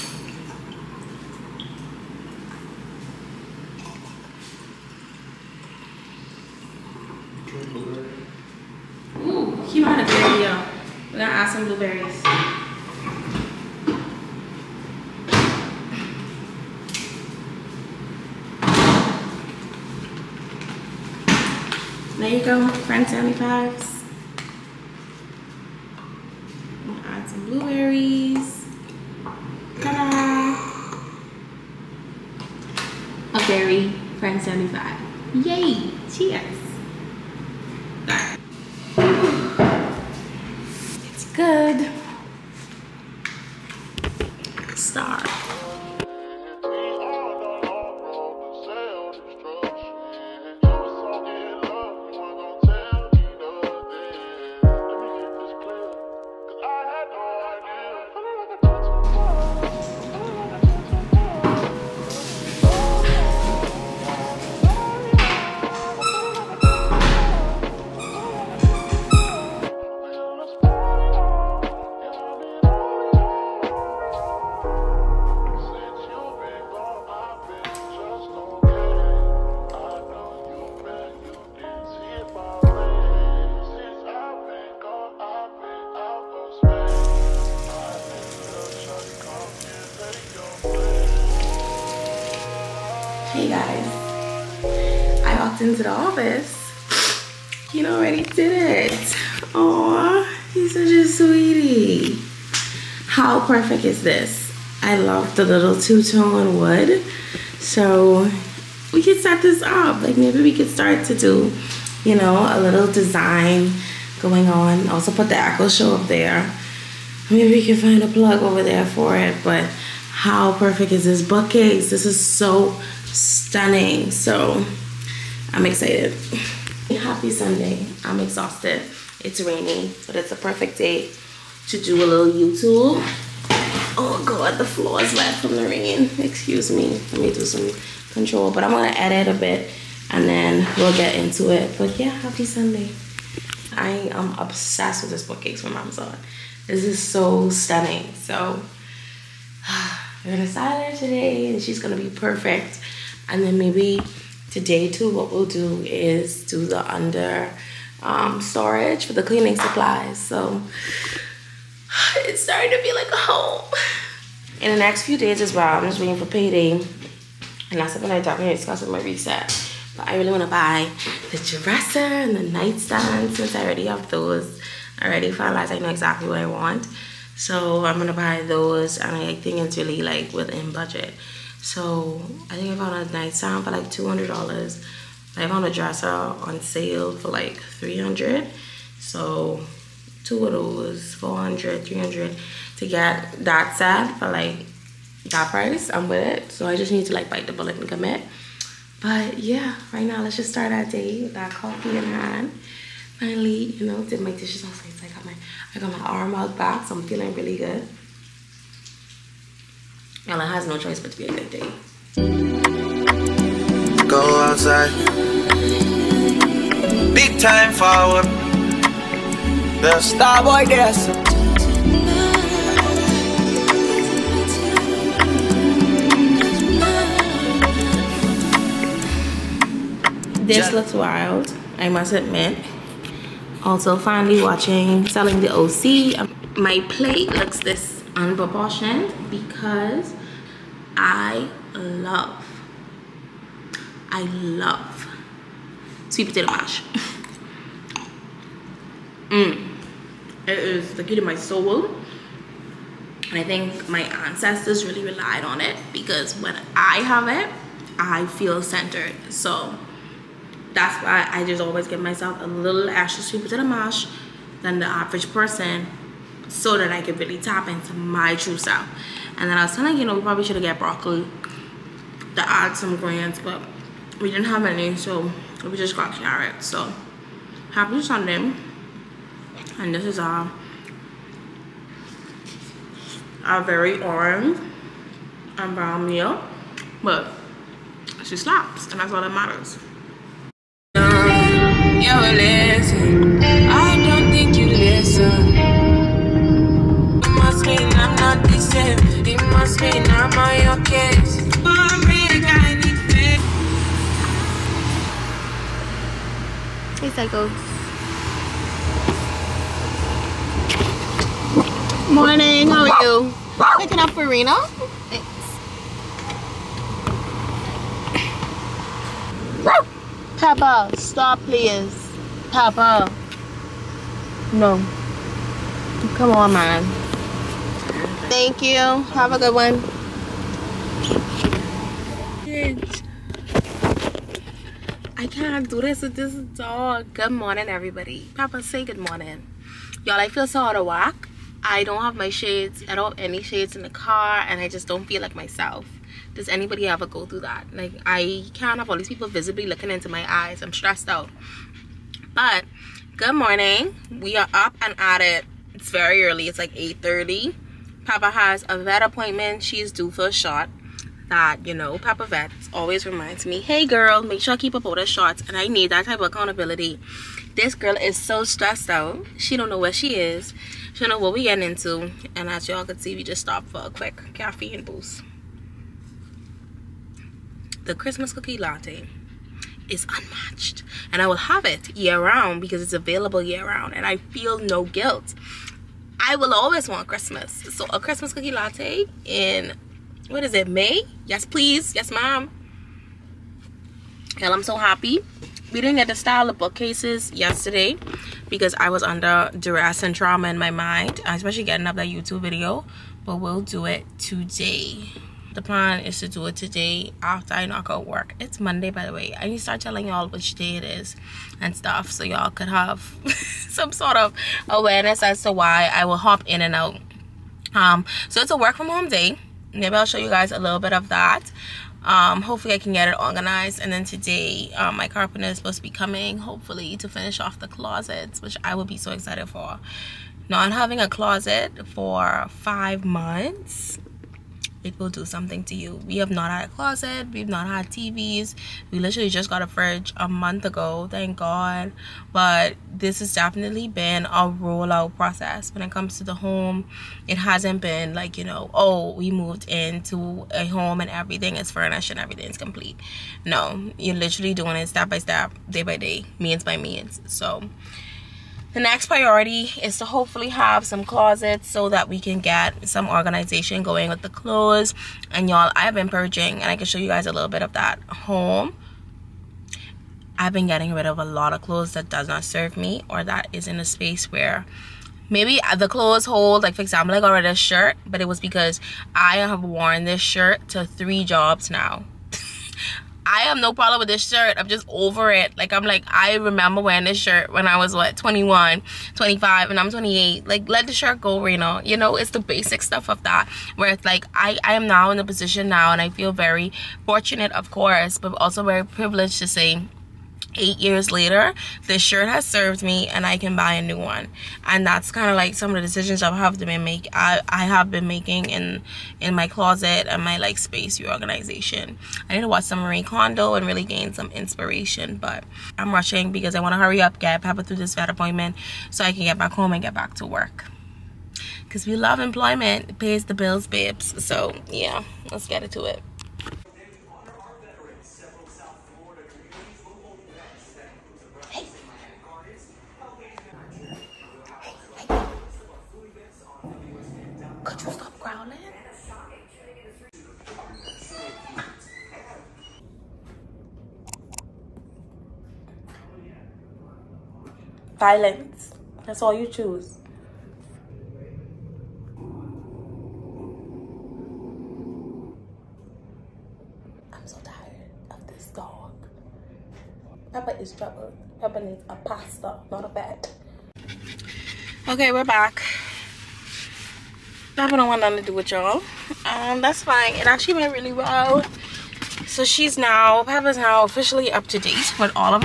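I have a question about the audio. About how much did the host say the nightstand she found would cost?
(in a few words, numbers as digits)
$200.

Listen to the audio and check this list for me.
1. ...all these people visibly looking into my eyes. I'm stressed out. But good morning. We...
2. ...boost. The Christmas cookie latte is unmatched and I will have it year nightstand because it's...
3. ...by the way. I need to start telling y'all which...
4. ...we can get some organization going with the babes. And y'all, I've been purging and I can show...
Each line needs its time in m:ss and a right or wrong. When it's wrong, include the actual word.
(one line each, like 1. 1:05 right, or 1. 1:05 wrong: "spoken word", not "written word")
1. 5:48 right
2. 6:14 wrong: "round", not "nightstand"
3. 6:48 right
4. 7:42 wrong: "clothes", not "babes".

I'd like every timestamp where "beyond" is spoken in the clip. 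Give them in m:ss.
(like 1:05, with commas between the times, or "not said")
not said.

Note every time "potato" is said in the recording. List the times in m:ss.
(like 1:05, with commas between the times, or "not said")
4:06, 4:23.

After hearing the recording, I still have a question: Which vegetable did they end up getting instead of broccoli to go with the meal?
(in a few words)
carrots.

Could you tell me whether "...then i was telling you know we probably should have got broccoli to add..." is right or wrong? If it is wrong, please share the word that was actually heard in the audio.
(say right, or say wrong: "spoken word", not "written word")
right.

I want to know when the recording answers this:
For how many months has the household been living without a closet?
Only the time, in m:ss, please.
7:12.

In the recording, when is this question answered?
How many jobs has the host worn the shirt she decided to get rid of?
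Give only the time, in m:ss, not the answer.
8:00.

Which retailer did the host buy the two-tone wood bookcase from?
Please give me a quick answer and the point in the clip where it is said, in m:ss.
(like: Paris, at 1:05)
Amazon, at 2:25.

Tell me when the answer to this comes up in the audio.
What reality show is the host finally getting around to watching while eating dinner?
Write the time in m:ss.
3:55.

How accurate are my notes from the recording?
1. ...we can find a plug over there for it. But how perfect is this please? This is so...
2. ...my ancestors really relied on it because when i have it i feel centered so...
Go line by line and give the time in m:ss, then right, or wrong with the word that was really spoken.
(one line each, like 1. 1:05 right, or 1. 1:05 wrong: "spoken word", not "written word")
1. 1:57 wrong: "bookcase", not "please"
2. 4:13 right.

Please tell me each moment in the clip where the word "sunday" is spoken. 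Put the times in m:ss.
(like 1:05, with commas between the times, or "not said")
2:07, 2:22, 4:38.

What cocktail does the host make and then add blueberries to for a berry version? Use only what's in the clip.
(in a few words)
French 75.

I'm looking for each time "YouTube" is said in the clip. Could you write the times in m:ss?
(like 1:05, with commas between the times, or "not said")
2:12, 6:42.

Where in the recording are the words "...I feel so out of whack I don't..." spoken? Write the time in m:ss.
5:40.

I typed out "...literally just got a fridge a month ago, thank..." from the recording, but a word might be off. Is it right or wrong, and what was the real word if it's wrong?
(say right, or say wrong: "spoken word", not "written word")
right.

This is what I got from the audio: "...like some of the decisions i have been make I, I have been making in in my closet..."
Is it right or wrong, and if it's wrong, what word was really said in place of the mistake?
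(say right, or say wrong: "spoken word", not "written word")
right.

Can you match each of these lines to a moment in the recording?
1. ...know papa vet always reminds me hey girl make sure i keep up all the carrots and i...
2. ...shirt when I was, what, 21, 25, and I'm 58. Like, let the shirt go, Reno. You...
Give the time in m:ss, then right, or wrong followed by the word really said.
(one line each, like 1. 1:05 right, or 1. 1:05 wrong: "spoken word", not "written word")
1. 6:01 wrong: "shots", not "carrots"
2. 8:07 wrong: "28", not "58".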